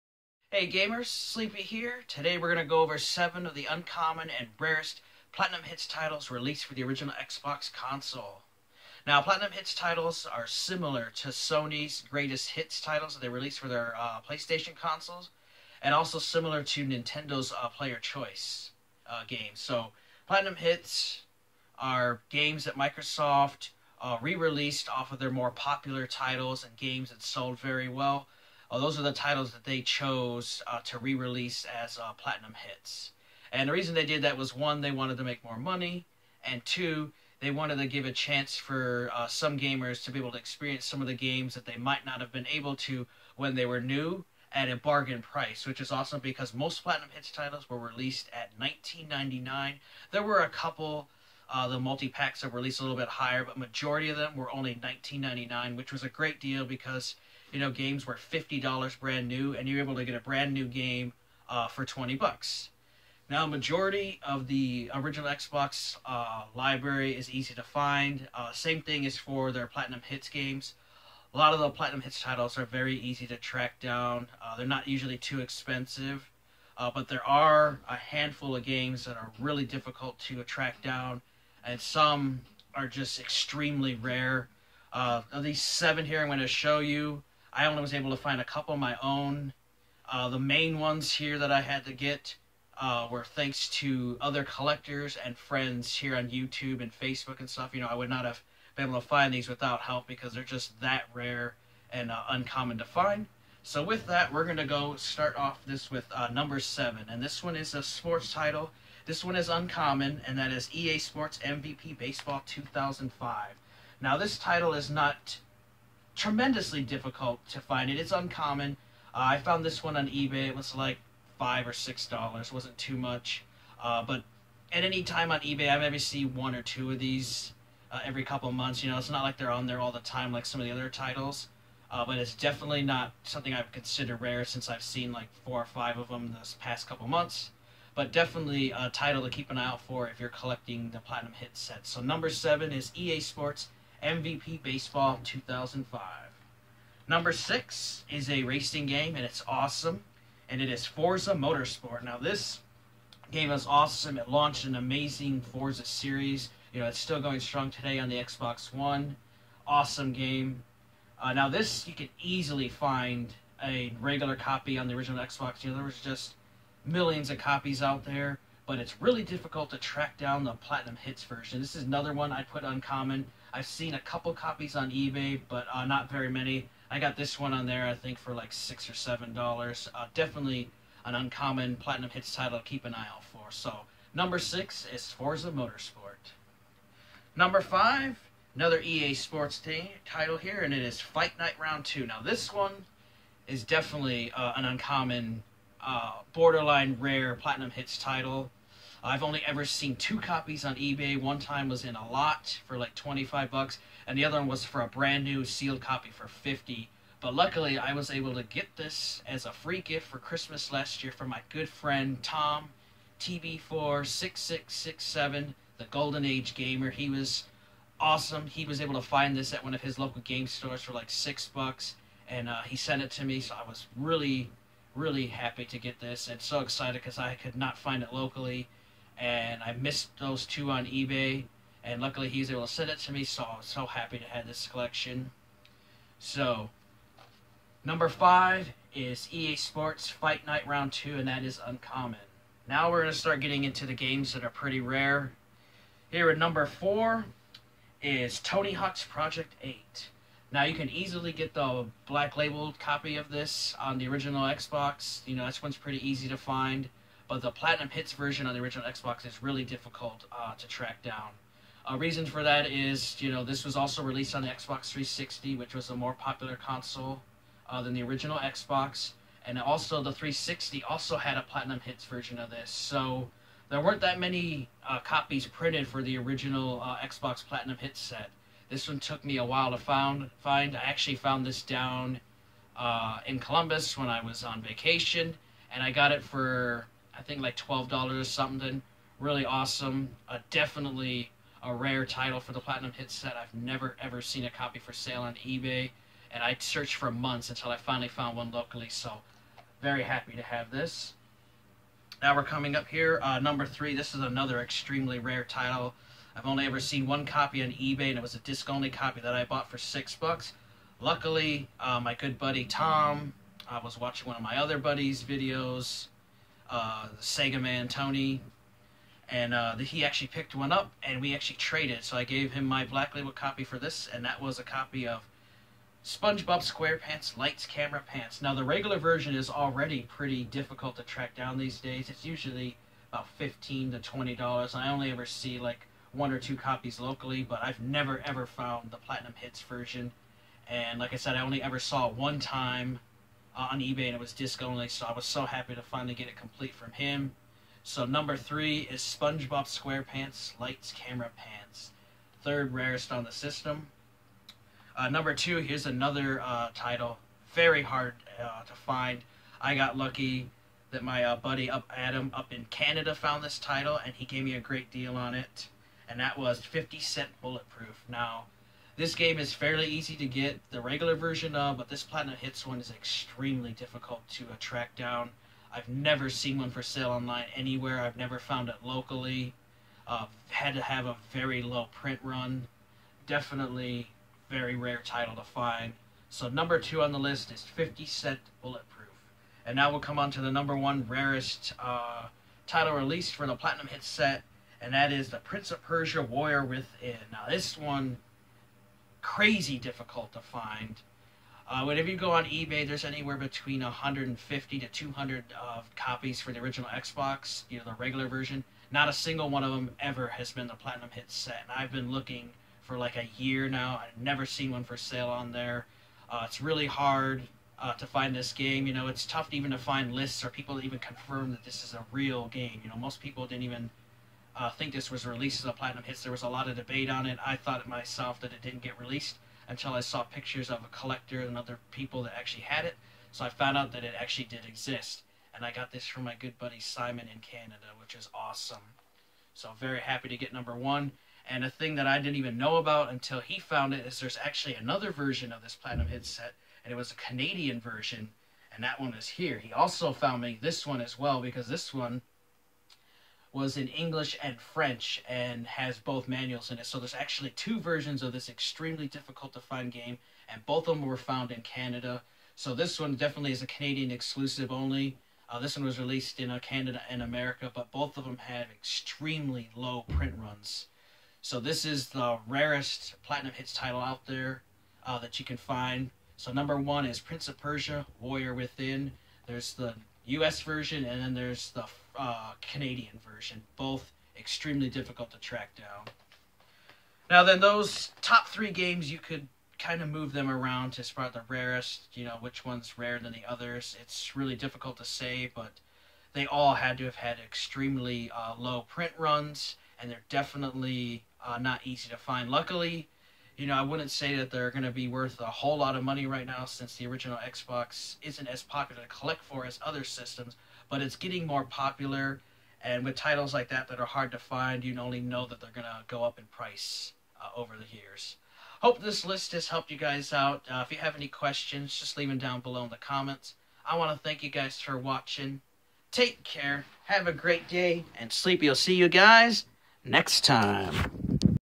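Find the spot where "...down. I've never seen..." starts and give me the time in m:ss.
6:14.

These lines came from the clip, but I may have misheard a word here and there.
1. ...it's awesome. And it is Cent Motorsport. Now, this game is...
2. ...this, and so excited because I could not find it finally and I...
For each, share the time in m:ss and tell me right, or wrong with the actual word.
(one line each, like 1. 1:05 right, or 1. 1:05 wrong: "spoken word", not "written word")
1. 2:29 wrong: "Forza", not "Cent"
2. 3:45 wrong: "locally", not "finally".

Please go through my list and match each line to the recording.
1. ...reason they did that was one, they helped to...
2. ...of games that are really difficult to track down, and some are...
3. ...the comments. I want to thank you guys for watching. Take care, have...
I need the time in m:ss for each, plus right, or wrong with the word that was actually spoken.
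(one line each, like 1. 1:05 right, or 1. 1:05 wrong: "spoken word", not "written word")
1. 0:33 wrong: "wanted", not "helped"
2. 1:18 right
3. 8:42 right.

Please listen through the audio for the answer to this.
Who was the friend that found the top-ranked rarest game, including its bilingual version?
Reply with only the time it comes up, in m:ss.
7:16.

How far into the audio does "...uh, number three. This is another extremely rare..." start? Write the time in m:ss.
5:03.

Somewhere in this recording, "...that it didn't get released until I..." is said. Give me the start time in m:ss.
7:08.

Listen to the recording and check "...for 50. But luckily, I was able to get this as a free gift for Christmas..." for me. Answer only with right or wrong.
right.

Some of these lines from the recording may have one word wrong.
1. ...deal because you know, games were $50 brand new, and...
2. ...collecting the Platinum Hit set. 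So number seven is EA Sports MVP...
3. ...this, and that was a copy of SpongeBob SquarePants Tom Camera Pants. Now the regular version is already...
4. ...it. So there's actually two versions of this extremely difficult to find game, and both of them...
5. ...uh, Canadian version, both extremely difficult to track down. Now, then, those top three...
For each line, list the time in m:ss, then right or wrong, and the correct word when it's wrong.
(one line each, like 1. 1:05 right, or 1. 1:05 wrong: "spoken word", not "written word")
1. 0:56 right
2. 2:20 right
3. 5:23 wrong: "Lights", not "Tom"
4. 7:36 right
5. 8:02 right.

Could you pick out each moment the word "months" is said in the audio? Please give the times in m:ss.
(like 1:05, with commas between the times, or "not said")
2:08, 2:17, 4:57.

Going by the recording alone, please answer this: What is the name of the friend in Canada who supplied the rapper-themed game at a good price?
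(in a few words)
Adam.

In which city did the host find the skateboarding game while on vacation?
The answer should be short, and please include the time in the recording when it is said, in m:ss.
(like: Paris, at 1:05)
Columbus, at 4:43.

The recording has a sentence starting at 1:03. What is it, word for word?
Now, majority of the original Xbox uh, library is easy to find.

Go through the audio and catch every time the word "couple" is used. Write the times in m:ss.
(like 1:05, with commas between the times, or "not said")
0:50, 1:28, 2:08, 2:16, 2:53.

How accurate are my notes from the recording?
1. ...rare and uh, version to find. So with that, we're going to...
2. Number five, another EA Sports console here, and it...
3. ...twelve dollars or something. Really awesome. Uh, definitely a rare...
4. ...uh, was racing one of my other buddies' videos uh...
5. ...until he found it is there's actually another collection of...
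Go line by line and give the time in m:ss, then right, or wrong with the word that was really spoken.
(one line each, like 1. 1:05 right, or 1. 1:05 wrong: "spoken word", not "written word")
1. 1:41 wrong: "uncommon", not "version"
2. 3:07 wrong: "title", not "console"
3. 4:47 right
4. 5:13 wrong: "watching", not "racing"
5. 7:23 wrong: "version", not "collection".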